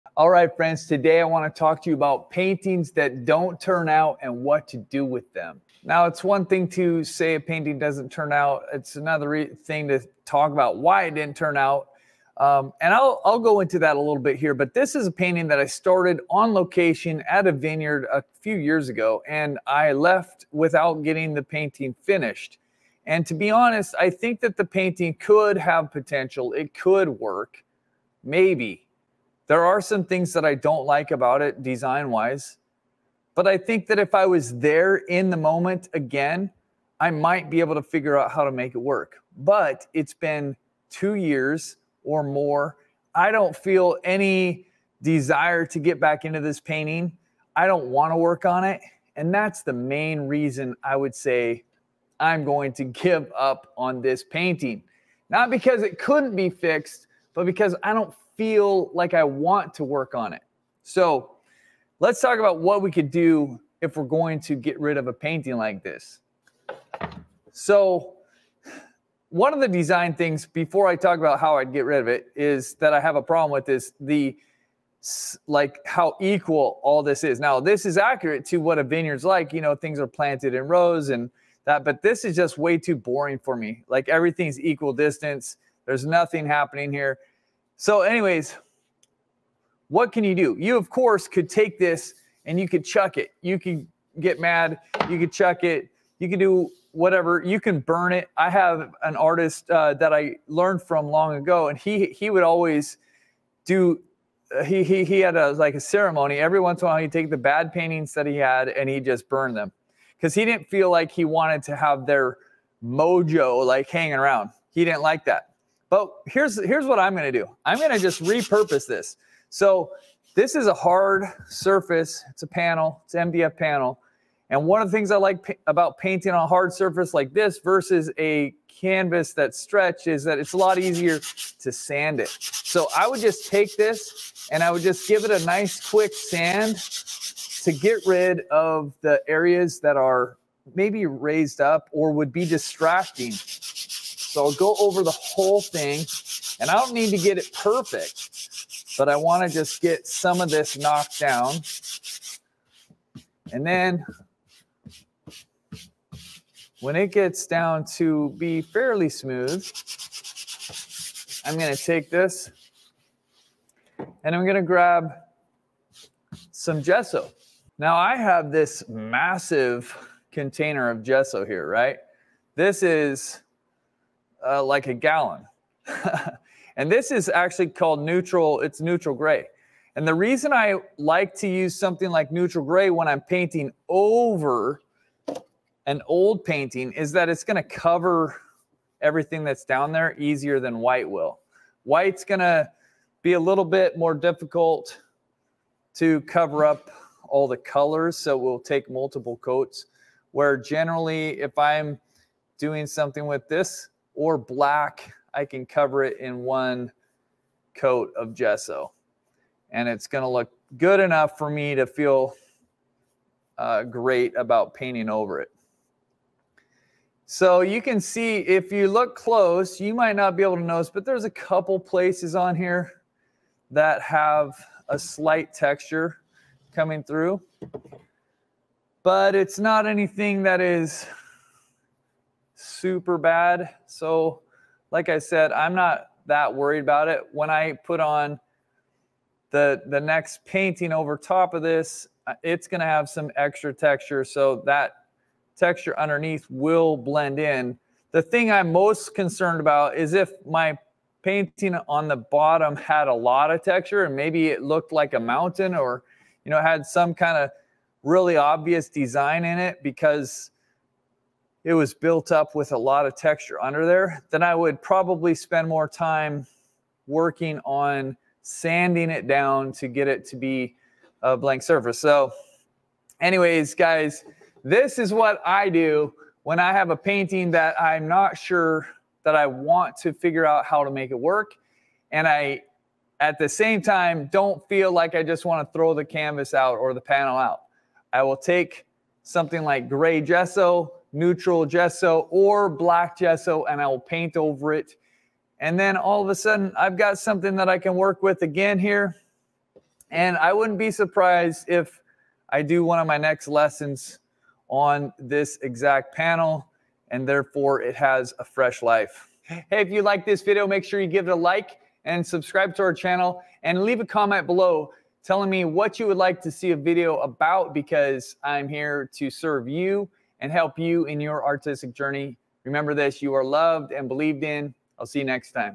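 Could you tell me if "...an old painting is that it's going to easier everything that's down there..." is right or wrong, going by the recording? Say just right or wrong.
wrong.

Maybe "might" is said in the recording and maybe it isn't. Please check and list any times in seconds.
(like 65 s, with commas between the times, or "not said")
37 s, 219 s.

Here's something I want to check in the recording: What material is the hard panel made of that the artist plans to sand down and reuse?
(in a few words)
MDF.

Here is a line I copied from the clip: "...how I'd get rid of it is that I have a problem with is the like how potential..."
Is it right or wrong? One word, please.
wrong.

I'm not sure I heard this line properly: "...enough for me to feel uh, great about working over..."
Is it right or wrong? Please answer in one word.
wrong.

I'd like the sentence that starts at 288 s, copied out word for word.
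I will take something like gray gesso, neutral gesso or black gesso and I'll paint over it.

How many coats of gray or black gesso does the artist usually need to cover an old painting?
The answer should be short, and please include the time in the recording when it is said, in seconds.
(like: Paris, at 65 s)
1, at 206 s.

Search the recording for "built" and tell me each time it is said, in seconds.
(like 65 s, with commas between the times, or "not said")
261 s.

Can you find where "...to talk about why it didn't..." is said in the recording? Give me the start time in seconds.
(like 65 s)
9 s.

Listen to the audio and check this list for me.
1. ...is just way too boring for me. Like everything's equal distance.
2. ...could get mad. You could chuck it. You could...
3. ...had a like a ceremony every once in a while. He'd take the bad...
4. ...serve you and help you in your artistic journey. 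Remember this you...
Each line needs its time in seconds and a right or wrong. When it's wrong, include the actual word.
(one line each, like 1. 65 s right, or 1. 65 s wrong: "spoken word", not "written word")
1. 82 s right
2. 93 s right
3. 105 s right
4. 319 s right.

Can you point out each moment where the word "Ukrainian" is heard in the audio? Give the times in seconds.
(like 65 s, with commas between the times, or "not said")
not said.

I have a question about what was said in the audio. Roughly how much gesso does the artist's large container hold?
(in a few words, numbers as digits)
A gallon.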